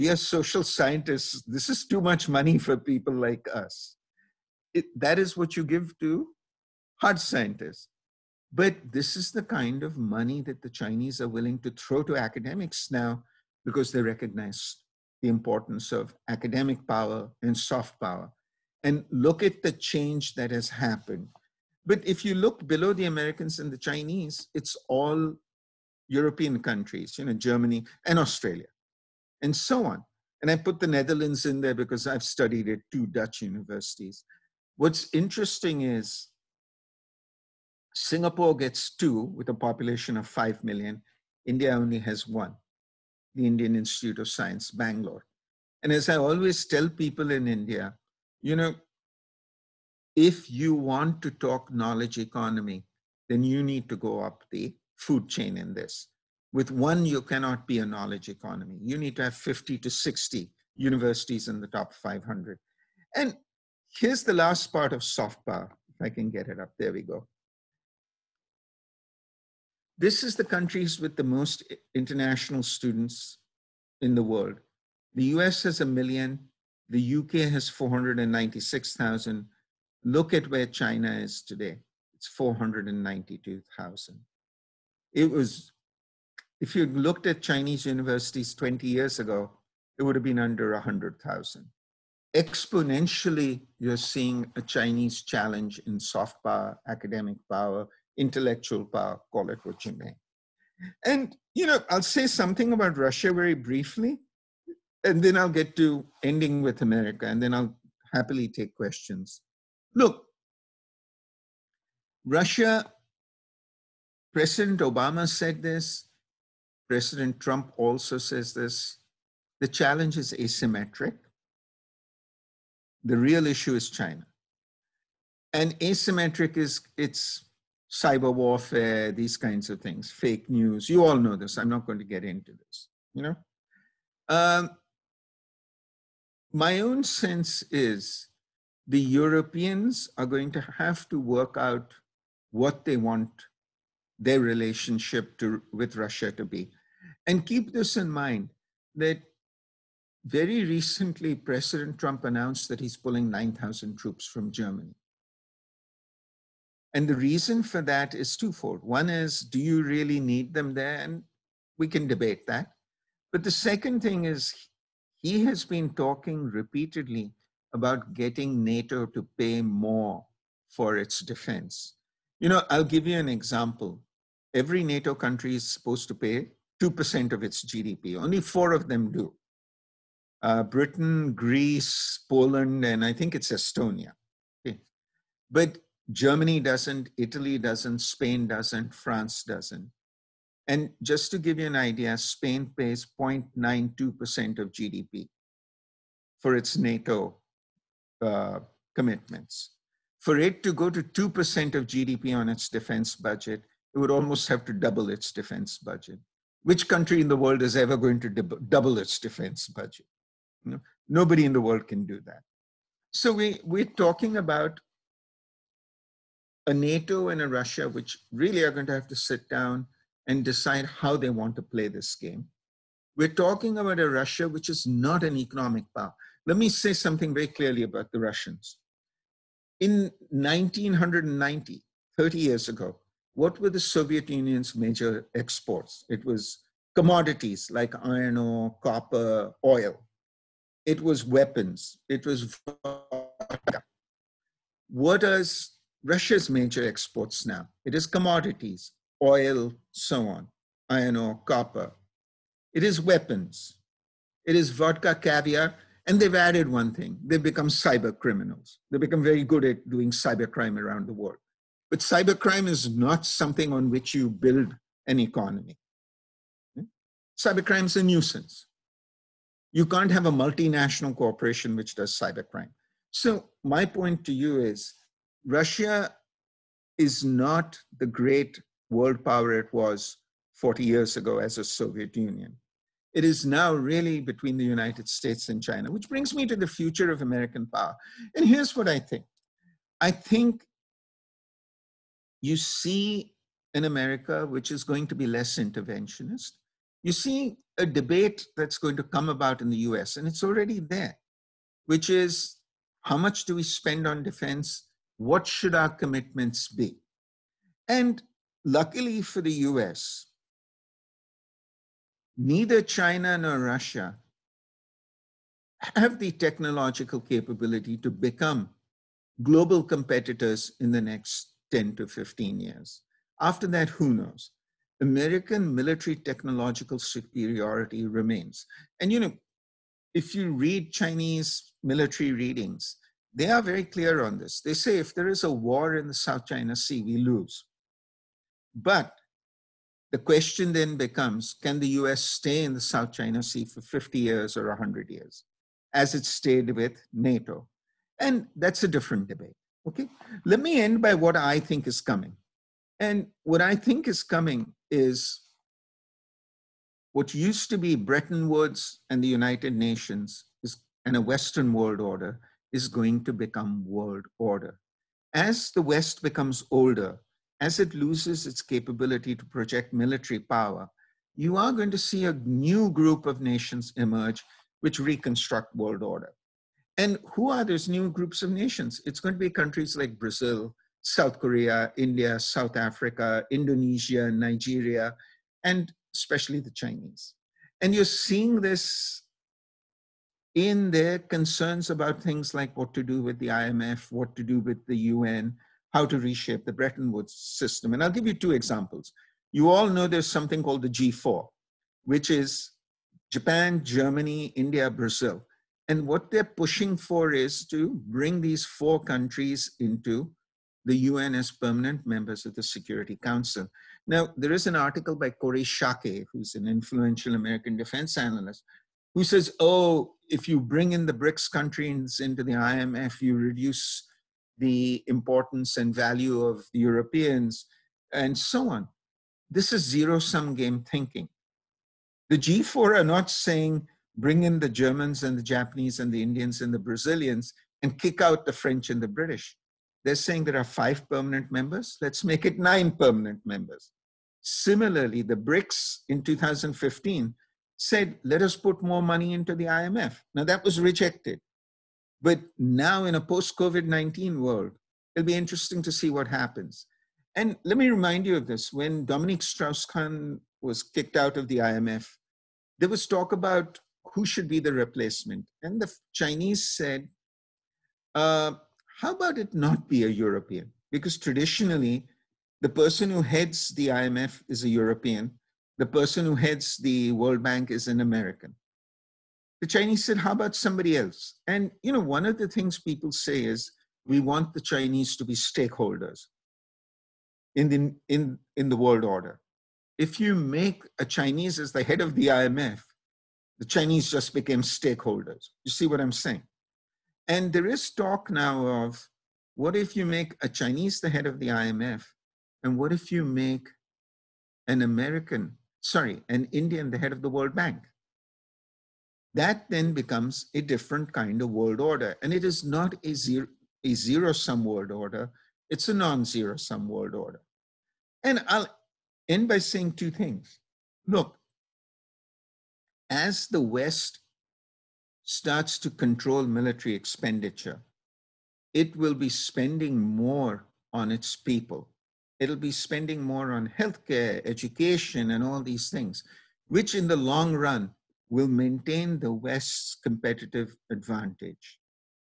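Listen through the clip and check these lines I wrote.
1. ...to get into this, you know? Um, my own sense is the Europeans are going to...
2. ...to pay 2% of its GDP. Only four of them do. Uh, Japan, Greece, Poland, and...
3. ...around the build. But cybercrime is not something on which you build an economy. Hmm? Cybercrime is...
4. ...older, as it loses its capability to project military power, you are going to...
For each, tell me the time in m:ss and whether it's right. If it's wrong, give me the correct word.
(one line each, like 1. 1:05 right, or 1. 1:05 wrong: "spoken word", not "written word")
1. 2:11 right
2. 2:56 wrong: "Britain", not "Japan"
3. 4:20 wrong: "world", not "build"
4. 6:06 right.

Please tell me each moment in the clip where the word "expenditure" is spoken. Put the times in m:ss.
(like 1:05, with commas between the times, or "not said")
8:46.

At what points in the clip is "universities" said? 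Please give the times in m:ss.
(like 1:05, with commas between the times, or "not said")
0:33, 1:00, 1:27.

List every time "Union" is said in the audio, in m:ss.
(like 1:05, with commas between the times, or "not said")
3:54, 4:42.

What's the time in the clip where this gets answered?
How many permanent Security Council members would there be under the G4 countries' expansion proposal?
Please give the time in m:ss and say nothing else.
7:22.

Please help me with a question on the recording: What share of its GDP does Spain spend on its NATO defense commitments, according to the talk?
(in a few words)
0.92%.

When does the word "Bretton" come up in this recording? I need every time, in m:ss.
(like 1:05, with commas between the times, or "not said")
5:57, 6:36.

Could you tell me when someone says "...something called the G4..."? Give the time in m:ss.
6:40.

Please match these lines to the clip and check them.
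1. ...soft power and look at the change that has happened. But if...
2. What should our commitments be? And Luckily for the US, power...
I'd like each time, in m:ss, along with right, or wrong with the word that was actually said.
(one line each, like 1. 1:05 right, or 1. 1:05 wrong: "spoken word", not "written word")
1. 0:17 right
2. 5:05 wrong: "neither", not "power".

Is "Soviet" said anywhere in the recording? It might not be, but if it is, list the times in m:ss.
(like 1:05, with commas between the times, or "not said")
3:53, 4:41.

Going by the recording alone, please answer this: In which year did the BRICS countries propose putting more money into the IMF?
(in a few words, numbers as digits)
2015.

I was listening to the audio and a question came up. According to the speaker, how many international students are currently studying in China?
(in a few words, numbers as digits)
492,000.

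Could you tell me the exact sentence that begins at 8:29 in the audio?
that then becomes a different kind of world order.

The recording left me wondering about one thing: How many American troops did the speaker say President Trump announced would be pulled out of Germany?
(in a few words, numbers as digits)
9,000.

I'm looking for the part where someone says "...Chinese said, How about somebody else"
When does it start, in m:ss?
7:59.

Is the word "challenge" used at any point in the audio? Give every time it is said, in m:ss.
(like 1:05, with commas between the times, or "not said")
1:35, 1:59.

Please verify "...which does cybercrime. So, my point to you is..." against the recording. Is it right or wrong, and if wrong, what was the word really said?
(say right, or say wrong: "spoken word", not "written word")
right.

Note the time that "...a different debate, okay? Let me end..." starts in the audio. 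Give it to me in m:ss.
5:48.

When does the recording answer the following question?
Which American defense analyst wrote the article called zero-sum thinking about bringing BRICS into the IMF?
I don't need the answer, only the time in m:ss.
6:55.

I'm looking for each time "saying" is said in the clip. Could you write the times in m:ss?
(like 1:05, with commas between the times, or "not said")
7:13, 7:20, 8:16, 8:39.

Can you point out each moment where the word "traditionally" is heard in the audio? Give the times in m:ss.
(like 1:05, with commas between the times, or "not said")
7:51.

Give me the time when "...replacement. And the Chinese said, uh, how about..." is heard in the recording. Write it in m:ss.
7:44.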